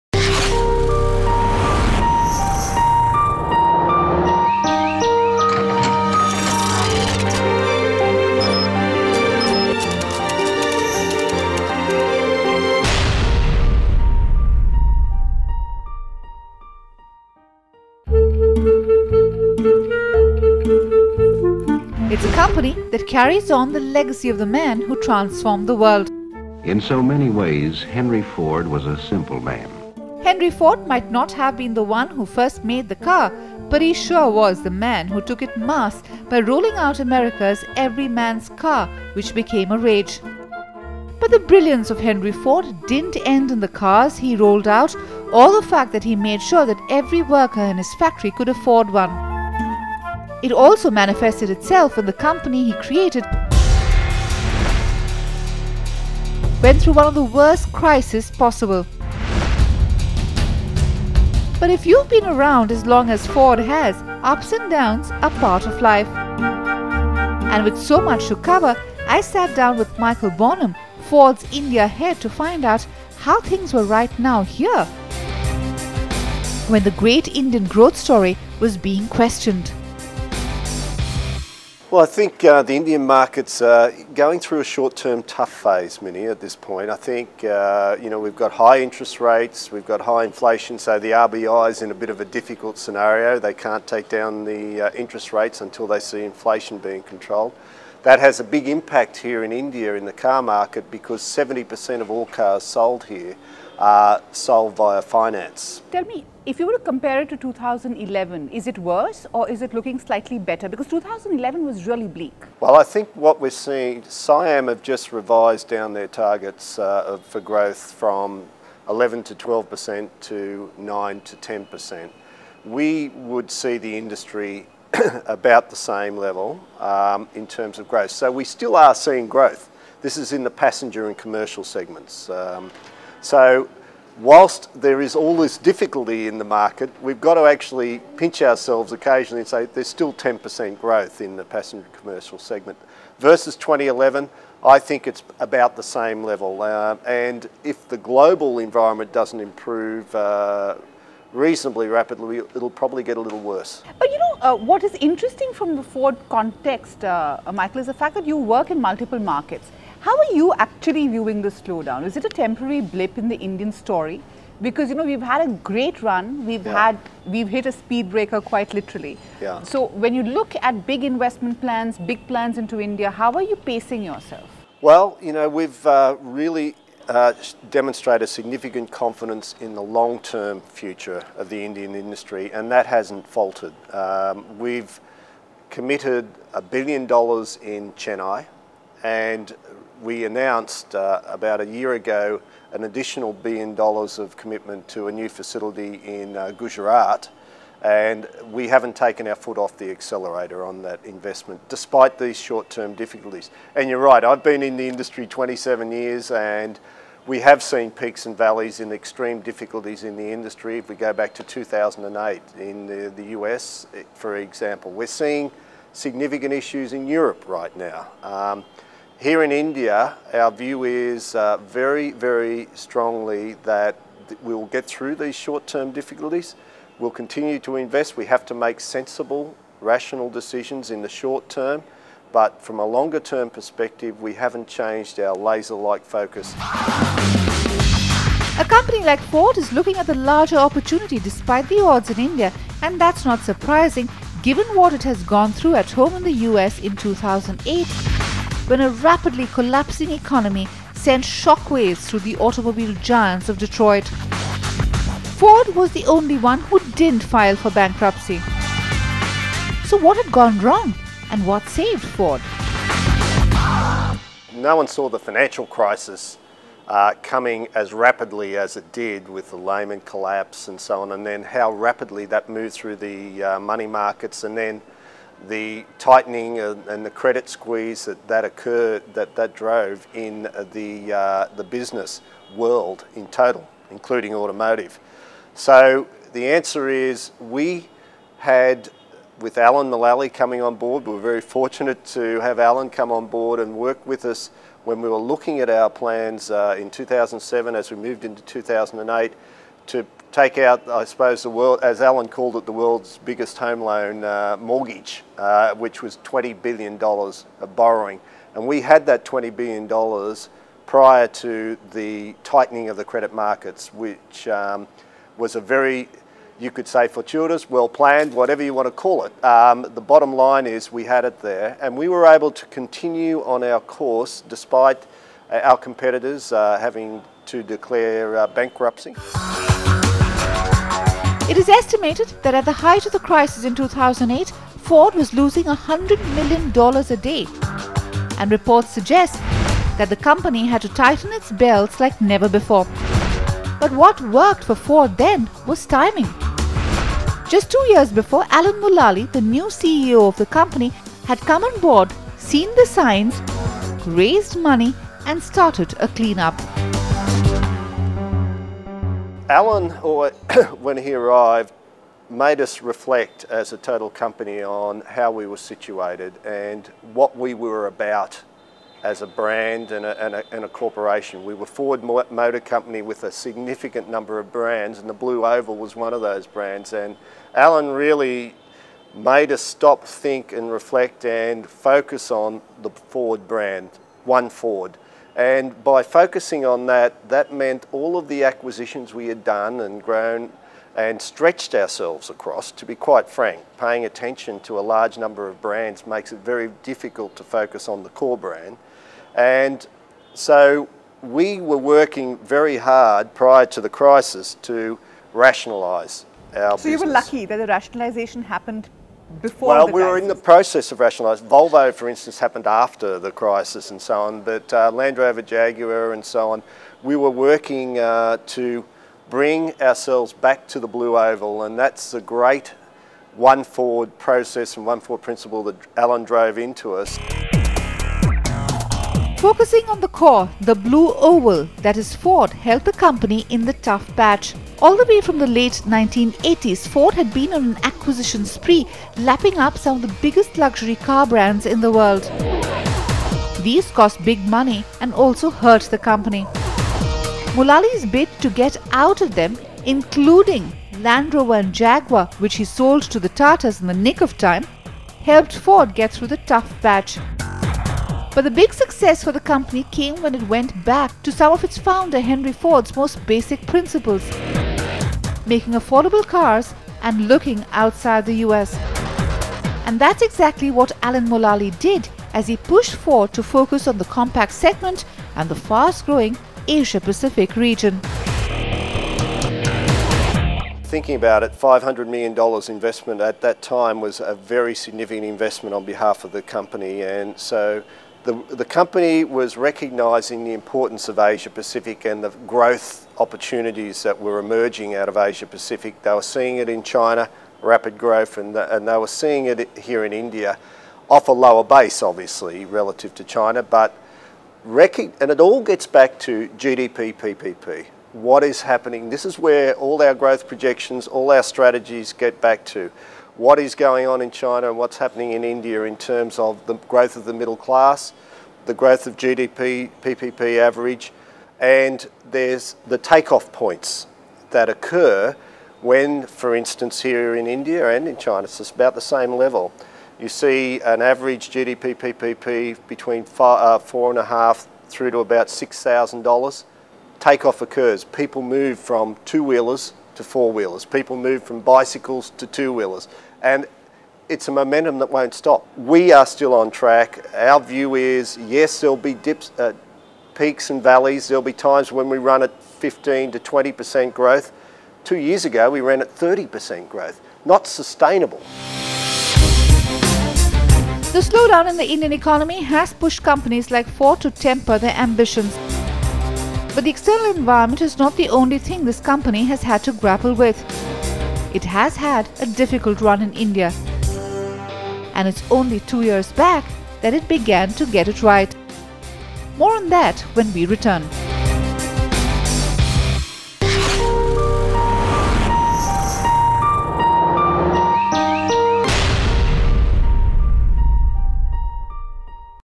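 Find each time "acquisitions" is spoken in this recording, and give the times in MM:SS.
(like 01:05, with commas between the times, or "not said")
06:28, 07:17.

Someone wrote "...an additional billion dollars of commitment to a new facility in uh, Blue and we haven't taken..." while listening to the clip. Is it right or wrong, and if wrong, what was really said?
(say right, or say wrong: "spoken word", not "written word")
wrong: "Gujarat", not "Blue".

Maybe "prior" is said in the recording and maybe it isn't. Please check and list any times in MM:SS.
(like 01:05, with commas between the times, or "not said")
05:10, 06:43.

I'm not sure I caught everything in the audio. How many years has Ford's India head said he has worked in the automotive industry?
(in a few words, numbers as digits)
27.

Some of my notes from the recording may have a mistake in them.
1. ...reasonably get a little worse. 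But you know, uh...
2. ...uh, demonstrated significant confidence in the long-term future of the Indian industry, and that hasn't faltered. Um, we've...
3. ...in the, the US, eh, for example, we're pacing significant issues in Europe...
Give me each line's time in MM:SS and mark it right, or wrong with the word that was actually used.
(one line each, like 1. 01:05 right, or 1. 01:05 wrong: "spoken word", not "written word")
1. 02:32 wrong: "probably", not "reasonably"
2. 02:57 right
3. 03:32 wrong: "seeing", not "pacing".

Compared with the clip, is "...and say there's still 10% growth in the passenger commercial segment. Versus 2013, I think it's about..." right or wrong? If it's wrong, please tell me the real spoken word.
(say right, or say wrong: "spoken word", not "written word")
wrong: "2011", not "2013".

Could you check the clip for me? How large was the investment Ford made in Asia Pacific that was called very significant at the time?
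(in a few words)
$500 million.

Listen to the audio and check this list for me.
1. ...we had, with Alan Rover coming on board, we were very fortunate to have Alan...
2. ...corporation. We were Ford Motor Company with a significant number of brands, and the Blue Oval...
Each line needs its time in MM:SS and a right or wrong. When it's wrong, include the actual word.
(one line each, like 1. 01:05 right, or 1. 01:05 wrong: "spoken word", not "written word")
1. 04:47 wrong: "Mulally", not "Rover"
2. 06:10 right.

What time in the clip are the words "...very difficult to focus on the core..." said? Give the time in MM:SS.
06:36.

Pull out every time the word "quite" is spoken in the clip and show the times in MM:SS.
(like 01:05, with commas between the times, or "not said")
02:48, 06:32.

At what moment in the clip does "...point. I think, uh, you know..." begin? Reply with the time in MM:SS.
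01:26.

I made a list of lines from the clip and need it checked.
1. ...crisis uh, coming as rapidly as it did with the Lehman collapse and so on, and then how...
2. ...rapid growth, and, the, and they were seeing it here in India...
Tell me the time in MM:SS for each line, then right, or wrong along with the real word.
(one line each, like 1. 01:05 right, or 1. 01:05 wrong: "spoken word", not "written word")
1. 04:25 right
2. 08:17 right.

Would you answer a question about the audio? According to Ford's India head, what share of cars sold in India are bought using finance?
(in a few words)
70%.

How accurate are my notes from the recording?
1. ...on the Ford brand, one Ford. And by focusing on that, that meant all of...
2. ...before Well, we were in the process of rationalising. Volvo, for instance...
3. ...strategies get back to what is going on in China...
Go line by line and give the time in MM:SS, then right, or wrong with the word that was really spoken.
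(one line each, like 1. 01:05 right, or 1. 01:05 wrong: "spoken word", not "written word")
1. 06:22 right
2. 06:49 right
3. 08:31 right.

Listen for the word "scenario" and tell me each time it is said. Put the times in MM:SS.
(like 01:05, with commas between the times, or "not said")
01:32.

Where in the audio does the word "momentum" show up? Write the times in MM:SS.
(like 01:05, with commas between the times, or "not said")
09:04.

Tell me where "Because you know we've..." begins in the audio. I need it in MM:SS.
02:44.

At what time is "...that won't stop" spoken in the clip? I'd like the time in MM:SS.
09:04.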